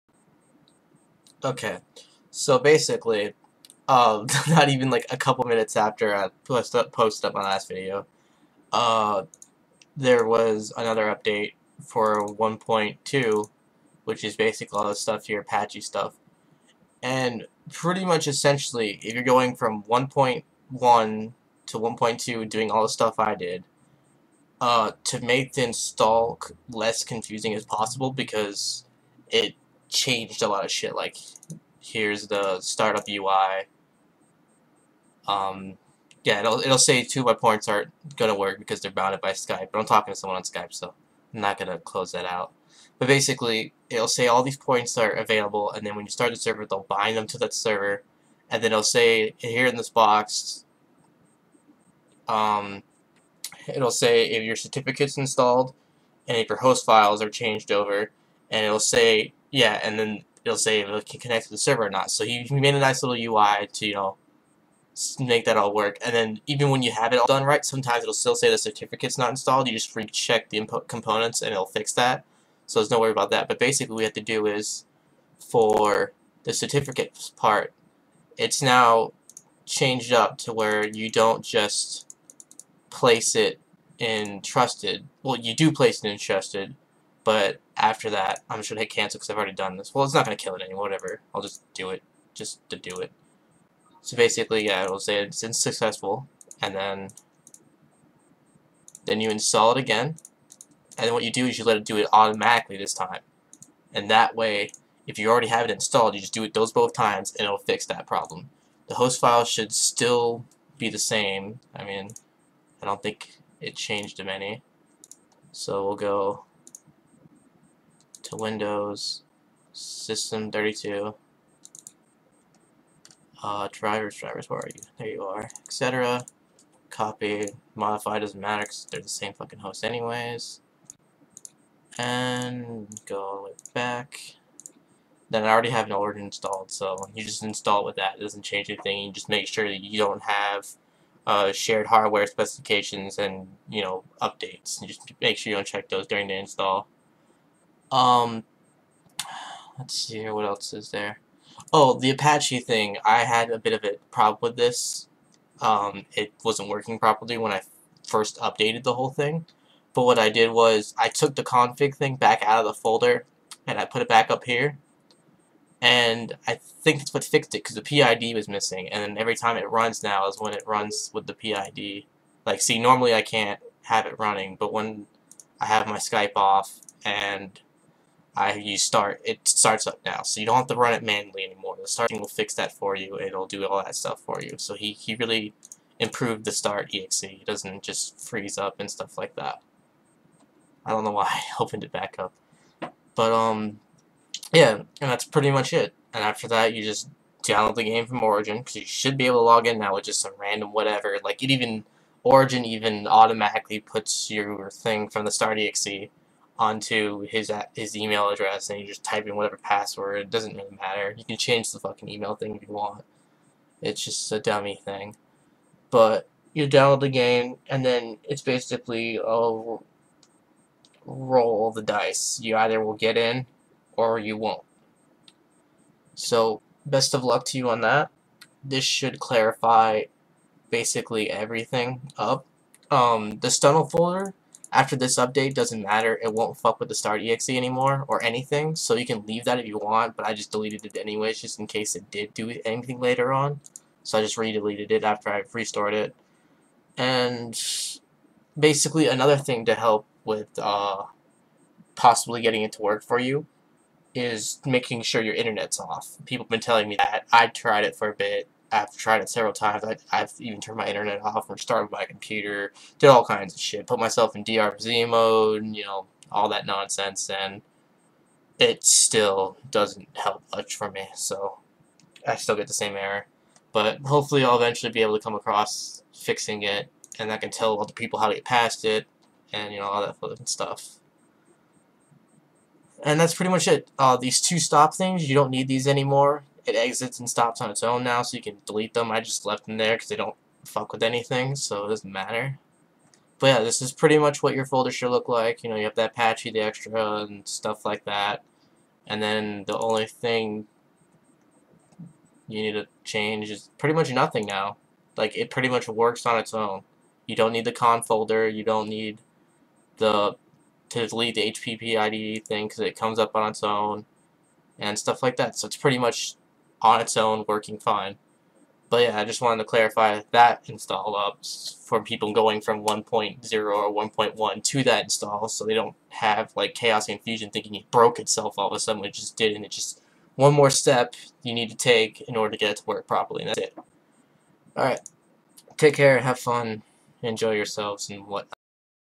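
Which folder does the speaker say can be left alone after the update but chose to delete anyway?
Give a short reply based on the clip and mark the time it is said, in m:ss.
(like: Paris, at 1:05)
Stunnel, at 3:53.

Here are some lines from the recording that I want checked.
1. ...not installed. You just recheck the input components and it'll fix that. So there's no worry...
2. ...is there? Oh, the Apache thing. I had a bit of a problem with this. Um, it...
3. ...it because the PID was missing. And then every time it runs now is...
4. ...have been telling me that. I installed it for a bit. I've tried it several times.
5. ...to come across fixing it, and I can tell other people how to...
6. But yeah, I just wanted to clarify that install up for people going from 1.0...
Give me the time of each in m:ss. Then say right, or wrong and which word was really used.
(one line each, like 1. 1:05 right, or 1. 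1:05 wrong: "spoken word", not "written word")
1. 1:09 right
2. 2:30 right
3. 2:47 right
4. 4:16 wrong: "tried", not "installed"
5. 4:35 right
6. 5:18 right.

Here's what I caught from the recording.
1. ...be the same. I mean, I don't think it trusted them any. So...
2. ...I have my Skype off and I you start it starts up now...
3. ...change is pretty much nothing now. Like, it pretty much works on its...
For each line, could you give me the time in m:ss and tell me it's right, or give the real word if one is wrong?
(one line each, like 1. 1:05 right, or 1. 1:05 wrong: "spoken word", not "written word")
1. 1:50 wrong: "changed", not "trusted"
2. 2:55 right
3. 5:03 right.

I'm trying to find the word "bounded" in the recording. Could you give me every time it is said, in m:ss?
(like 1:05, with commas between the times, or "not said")
0:38.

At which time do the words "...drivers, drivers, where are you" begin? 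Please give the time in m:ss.
2:03.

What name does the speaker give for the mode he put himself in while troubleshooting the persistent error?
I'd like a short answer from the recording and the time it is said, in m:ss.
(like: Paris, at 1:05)
DRZ mode, at 4:24.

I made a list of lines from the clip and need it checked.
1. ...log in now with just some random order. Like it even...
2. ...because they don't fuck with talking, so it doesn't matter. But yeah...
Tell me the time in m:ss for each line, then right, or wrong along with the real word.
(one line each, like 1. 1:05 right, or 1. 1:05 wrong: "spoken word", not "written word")
1. 3:19 wrong: "whatever", not "order"
2. 4:49 wrong: "anything", not "talking".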